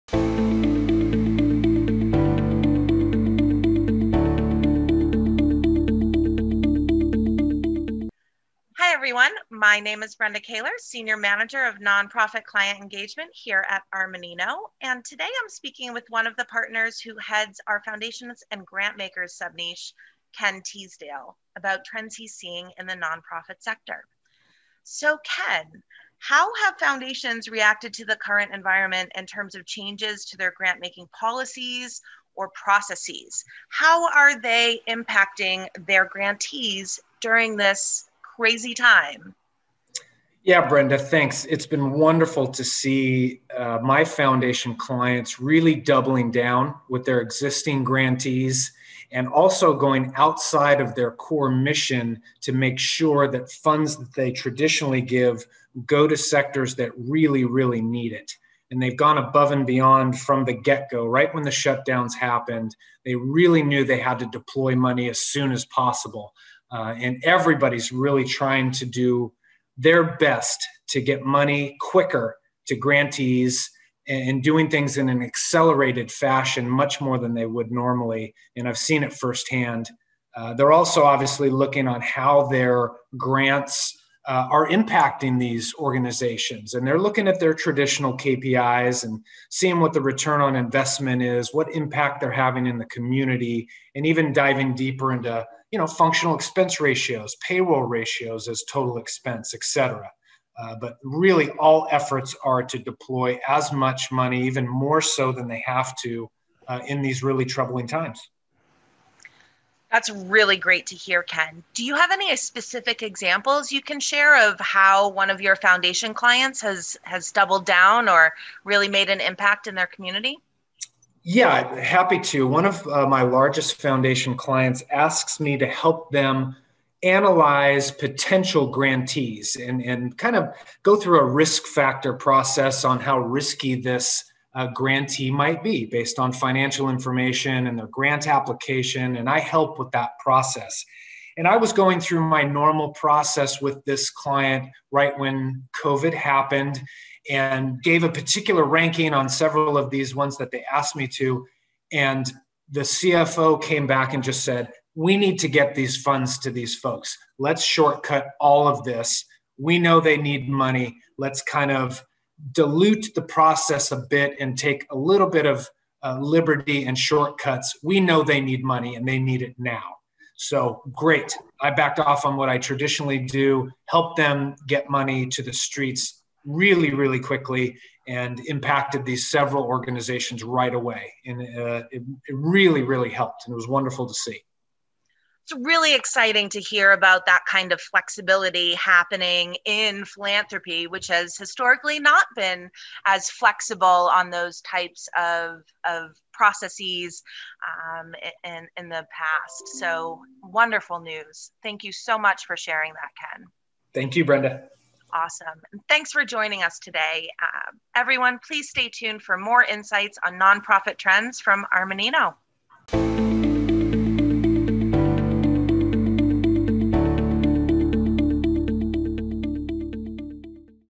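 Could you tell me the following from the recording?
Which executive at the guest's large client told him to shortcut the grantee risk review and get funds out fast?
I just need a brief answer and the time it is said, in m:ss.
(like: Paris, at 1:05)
The CFO, at 2:32.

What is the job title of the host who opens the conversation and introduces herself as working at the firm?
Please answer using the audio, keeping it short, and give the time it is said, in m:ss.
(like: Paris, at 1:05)
Senior Manager of Nonprofit Client Engagement, at 0:10.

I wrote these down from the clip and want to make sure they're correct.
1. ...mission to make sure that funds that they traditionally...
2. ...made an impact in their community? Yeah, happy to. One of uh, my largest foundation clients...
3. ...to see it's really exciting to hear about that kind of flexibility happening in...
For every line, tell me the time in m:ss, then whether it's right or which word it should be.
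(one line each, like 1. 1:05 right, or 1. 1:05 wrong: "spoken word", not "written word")
1. 0:51 right
2. 1:58 right
3. 3:04 right.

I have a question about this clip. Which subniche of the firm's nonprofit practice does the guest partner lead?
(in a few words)
Foundations and Grant Makers.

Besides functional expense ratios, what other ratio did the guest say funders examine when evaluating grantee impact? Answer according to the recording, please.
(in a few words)
payroll ratios.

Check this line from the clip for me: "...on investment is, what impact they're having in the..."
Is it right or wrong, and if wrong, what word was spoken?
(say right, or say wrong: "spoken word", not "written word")
right.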